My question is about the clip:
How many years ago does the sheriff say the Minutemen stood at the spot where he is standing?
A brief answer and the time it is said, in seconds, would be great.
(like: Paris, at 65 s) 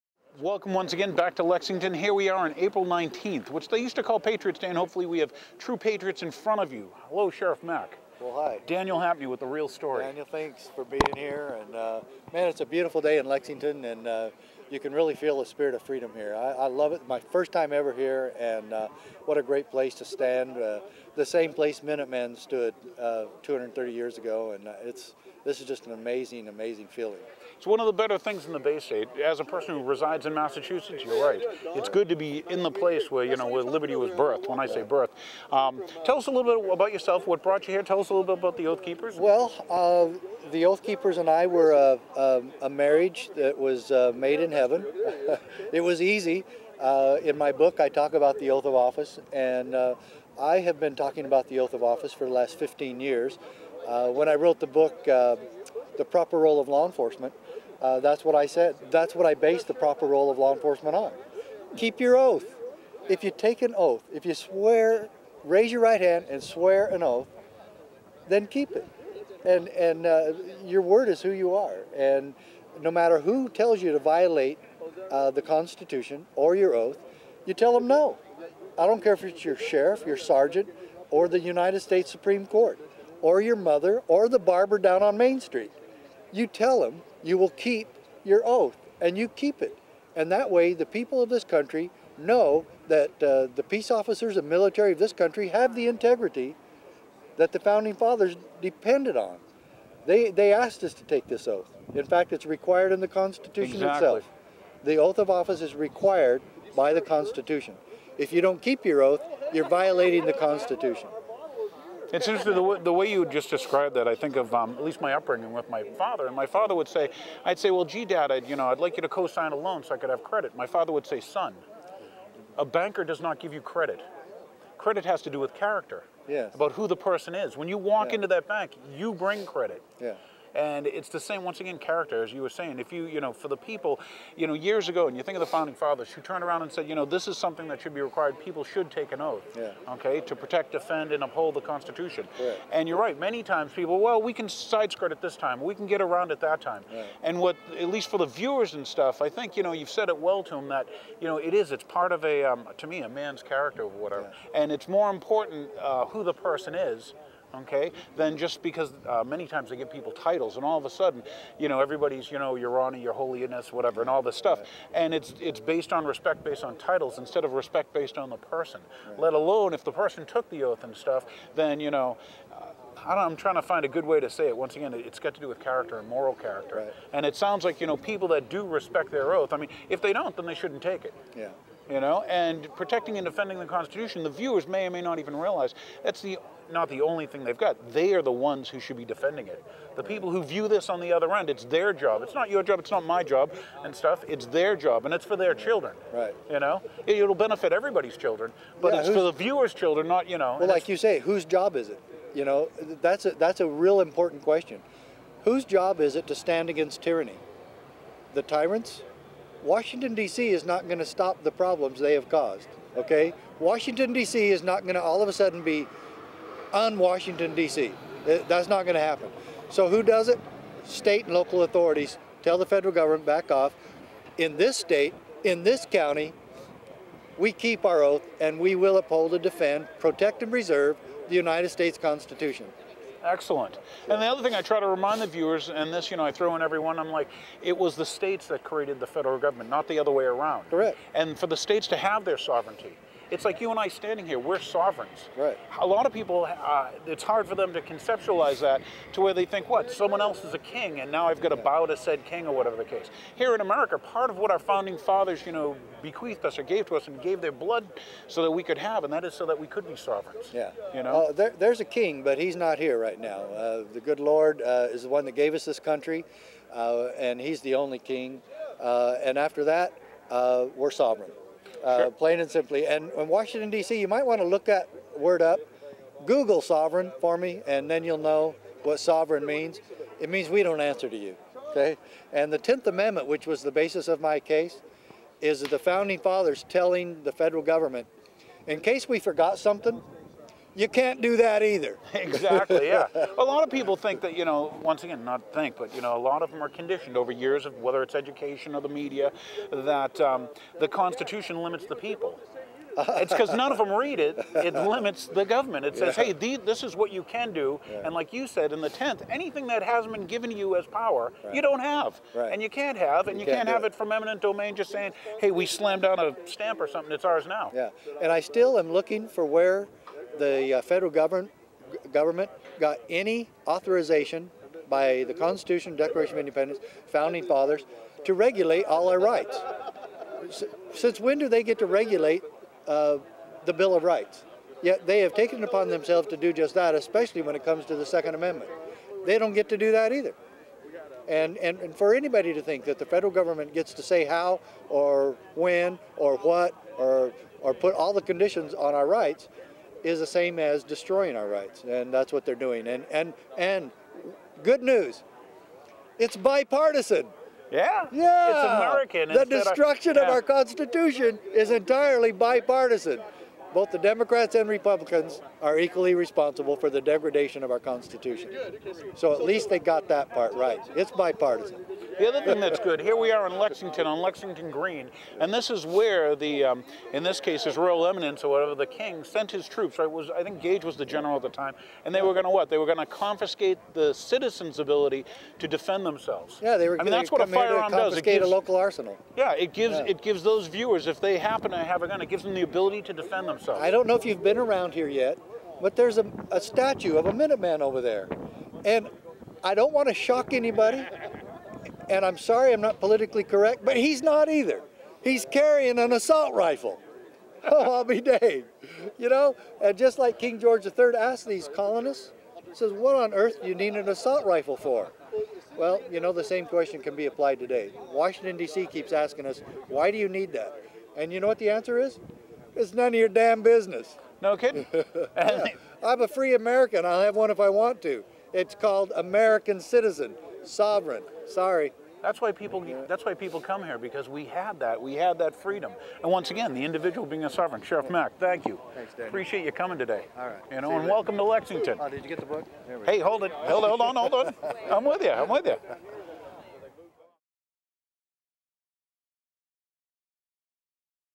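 230, at 23 s.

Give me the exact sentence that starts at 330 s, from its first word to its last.
Since when do they get to regulate uh, the Bill of Rights?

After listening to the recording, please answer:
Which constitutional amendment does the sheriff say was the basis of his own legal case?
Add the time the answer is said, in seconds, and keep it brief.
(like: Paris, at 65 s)
10th Amendment, at 282 s.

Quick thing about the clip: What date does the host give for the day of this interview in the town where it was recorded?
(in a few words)
April 19th.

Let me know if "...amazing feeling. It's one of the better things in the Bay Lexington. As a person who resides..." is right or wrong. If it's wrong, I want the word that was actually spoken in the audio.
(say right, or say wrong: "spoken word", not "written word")
wrong: "State", not "Lexington".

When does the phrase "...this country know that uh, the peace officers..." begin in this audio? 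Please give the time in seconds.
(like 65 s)
91 s.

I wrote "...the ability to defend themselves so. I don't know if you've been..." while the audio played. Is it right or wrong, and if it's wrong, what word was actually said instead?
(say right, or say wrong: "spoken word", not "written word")
right.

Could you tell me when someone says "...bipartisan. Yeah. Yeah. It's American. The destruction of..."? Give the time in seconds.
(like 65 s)
356 s.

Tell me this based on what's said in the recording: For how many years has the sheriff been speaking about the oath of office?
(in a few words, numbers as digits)
15 years.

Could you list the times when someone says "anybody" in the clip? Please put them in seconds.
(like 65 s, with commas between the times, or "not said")
342 s, 400 s.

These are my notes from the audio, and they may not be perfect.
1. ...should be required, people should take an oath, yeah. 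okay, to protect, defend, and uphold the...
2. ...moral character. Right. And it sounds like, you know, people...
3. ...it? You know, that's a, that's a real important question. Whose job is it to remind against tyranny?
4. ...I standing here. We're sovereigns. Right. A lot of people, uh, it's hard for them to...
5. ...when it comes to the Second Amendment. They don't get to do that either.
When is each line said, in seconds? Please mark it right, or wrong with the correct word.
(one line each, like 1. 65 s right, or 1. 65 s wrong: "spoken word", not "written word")
1. 137 s right
2. 176 s right
3. 201 s wrong: "stand", not "remind"
4. 243 s right
5. 337 s right.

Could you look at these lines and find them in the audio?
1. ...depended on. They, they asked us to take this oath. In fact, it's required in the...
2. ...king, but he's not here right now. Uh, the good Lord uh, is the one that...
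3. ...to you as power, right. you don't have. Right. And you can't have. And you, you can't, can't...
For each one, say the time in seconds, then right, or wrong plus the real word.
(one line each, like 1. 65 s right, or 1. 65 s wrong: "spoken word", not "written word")
1. 98 s right
2. 261 s right
3. 310 s right.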